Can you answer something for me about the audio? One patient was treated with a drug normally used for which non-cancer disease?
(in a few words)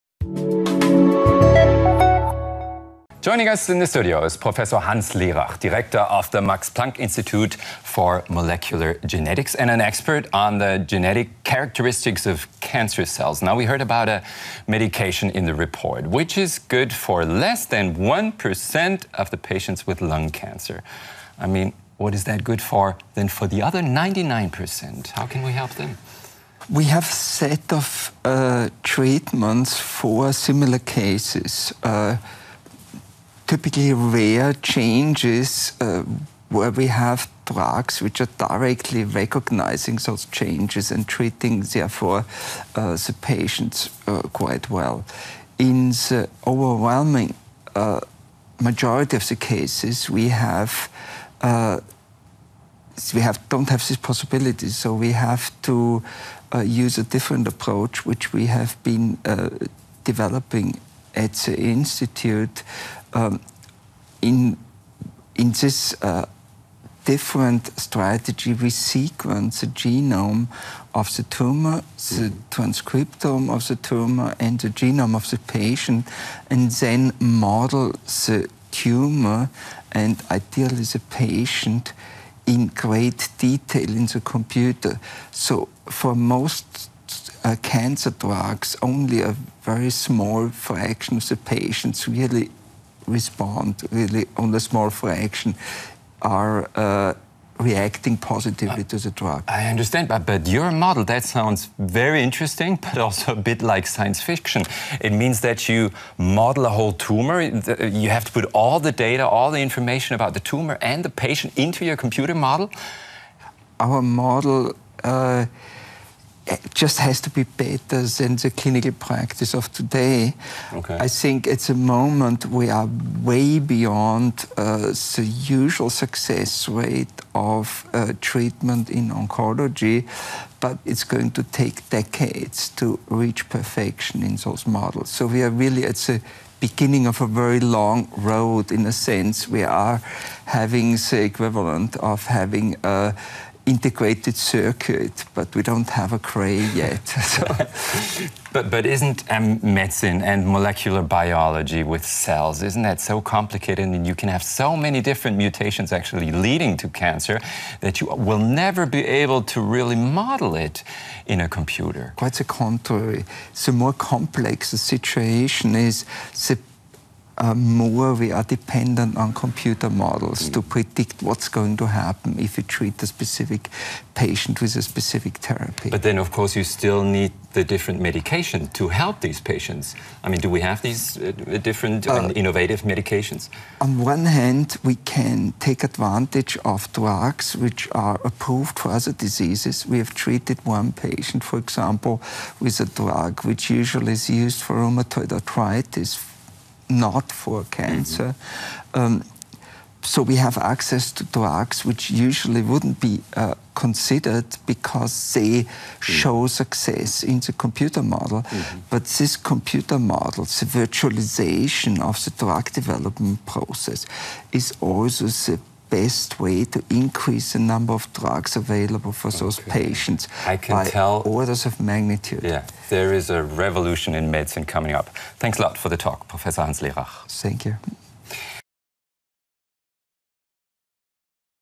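rheumatoid arthritis.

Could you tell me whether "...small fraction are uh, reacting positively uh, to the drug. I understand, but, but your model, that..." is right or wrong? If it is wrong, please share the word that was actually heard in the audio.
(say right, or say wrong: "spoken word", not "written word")
right.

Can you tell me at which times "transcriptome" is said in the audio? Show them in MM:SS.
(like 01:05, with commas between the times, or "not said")
01:12.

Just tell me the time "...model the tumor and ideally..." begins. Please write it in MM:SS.
01:17.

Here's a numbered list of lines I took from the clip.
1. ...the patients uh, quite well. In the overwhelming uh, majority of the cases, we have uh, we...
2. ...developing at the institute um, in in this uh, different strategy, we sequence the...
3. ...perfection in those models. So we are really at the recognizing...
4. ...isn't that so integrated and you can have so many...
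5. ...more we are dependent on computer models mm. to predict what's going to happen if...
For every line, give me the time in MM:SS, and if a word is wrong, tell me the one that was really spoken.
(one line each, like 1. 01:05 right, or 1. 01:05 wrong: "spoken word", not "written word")
1. 00:42 right
2. 01:00 right
3. 02:13 wrong: "beginning", not "recognizing"
4. 02:32 wrong: "complicated", not "integrated"
5. 02:47 right.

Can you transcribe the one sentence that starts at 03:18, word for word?
Um, so we have access to drugs which usually wouldn't be uh, considered because they mm.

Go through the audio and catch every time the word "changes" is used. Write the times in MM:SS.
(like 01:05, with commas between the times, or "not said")
00:34, 00:40.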